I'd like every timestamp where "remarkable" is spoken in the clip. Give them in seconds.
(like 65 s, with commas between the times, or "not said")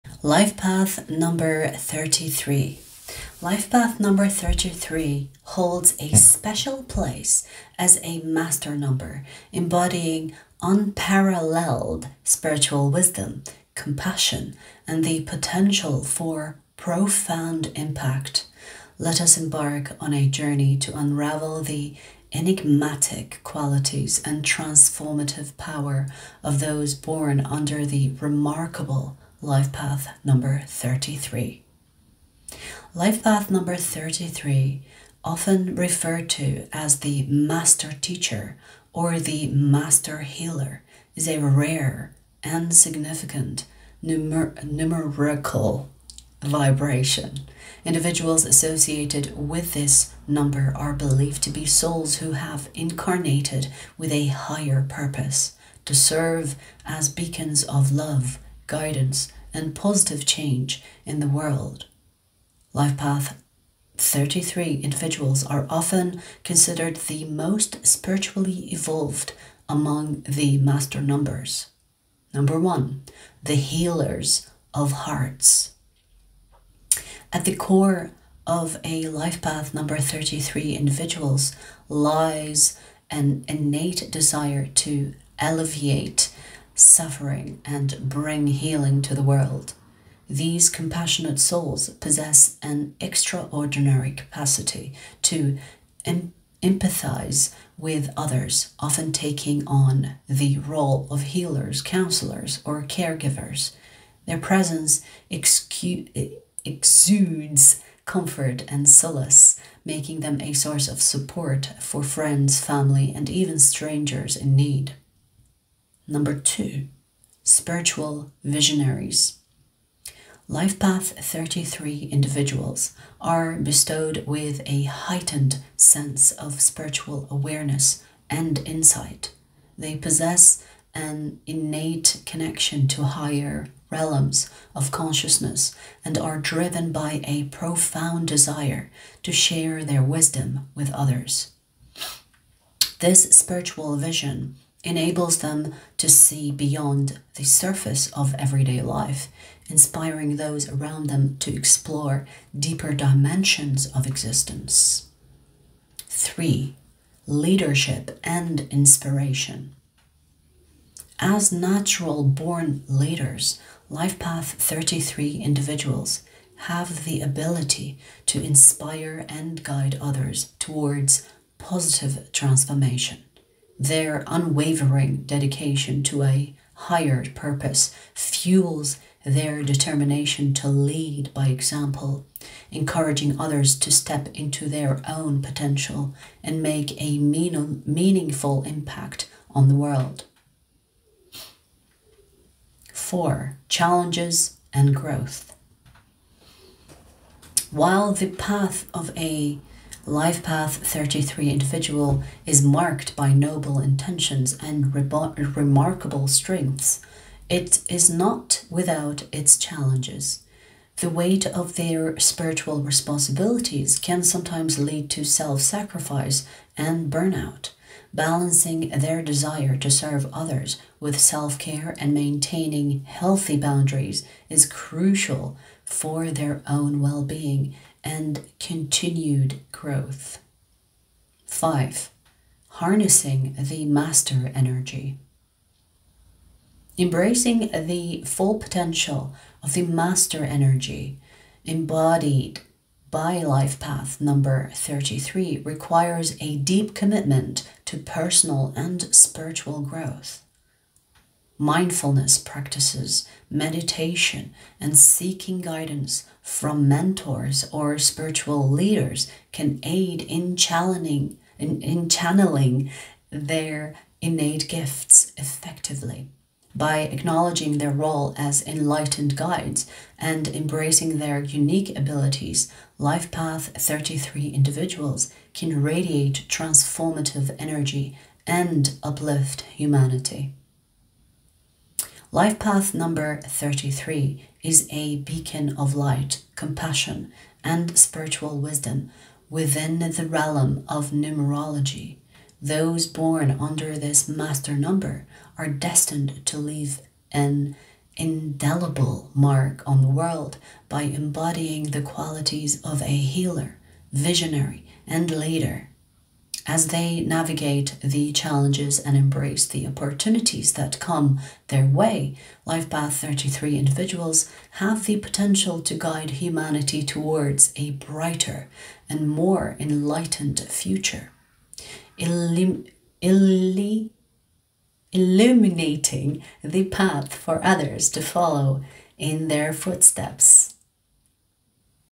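28 s, 204 s.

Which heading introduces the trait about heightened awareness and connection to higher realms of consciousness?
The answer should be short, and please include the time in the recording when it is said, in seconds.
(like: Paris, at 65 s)
Spiritual visionaries, at 117 s.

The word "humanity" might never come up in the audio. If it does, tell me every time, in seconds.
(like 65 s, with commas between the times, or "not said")
279 s, 316 s.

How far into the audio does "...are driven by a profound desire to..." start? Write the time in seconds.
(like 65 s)
136 s.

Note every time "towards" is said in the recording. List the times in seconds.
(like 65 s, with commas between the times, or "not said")
170 s, 317 s.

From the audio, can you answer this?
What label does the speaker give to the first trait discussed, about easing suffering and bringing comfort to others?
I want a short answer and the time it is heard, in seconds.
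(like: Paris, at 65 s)
Healers of hearts, at 73 s.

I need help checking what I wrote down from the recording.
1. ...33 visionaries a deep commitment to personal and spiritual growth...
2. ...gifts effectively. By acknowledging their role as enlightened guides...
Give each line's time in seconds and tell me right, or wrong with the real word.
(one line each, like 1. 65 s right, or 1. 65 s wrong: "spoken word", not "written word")
1. 244 s wrong: "requires", not "visionaries"
2. 264 s right.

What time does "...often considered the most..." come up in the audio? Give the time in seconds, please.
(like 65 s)
65 s.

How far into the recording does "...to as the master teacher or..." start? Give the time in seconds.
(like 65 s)
36 s.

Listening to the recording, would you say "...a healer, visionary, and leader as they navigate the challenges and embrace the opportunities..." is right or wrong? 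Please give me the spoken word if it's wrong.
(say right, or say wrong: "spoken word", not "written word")
right.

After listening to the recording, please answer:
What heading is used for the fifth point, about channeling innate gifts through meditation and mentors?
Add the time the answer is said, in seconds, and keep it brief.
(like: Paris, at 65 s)
Harnessing the master energy, at 232 s.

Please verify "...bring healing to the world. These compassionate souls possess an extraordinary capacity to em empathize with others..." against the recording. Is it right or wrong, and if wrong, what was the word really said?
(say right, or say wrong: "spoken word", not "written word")
right.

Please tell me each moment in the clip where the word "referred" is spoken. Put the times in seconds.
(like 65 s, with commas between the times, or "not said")
35 s.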